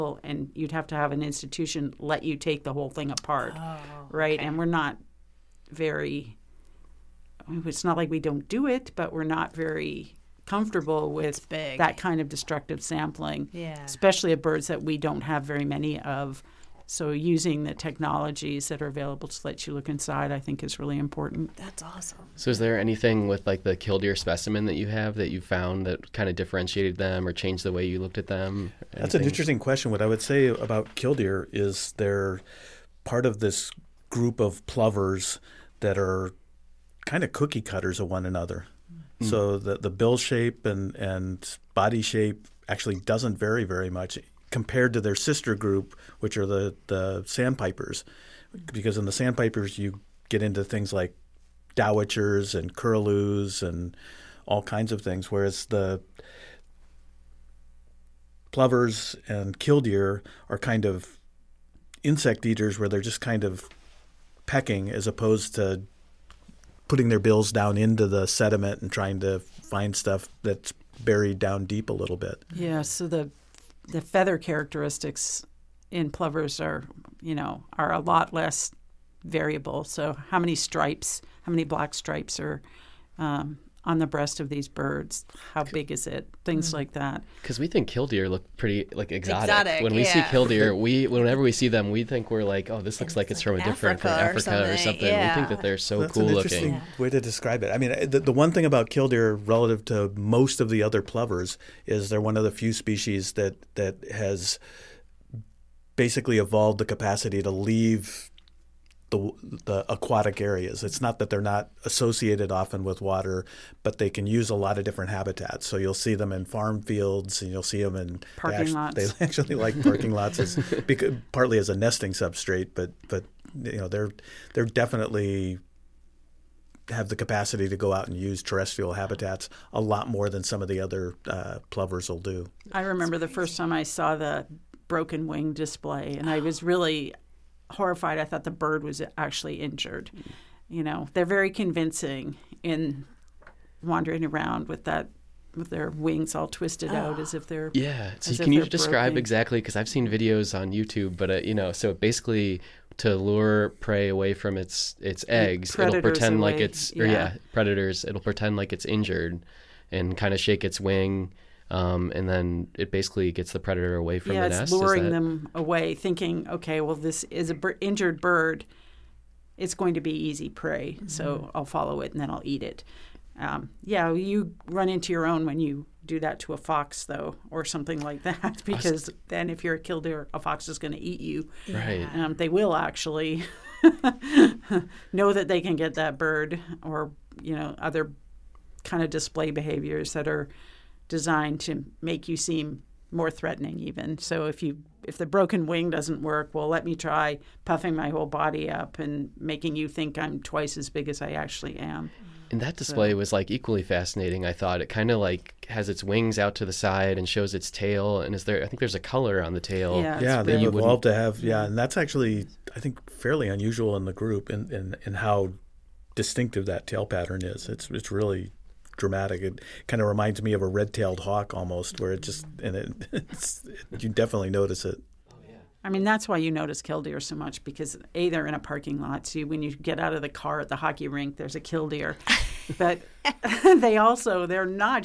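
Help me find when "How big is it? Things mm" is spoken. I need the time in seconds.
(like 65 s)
85 s.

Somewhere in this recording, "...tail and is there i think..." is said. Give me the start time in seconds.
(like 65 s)
207 s.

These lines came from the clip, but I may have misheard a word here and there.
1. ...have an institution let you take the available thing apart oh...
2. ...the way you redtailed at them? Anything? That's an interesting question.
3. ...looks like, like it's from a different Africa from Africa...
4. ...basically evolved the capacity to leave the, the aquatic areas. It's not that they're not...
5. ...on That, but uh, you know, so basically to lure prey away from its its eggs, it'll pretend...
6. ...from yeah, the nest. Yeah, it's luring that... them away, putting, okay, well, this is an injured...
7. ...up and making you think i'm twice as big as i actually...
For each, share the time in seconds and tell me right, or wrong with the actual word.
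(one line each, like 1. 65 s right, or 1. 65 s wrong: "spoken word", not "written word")
1. 0 s wrong: "whole", not "available"
2. 27 s wrong: "looked", not "redtailed"
3. 92 s right
4. 105 s right
5. 150 s wrong: "YouTube", not "That"
6. 164 s wrong: "thinking", not "putting"
7. 198 s right.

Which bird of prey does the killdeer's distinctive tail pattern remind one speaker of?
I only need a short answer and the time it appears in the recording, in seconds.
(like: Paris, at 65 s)
red-tailed hawk, at 220 s.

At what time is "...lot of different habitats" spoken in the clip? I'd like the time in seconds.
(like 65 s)
114 s.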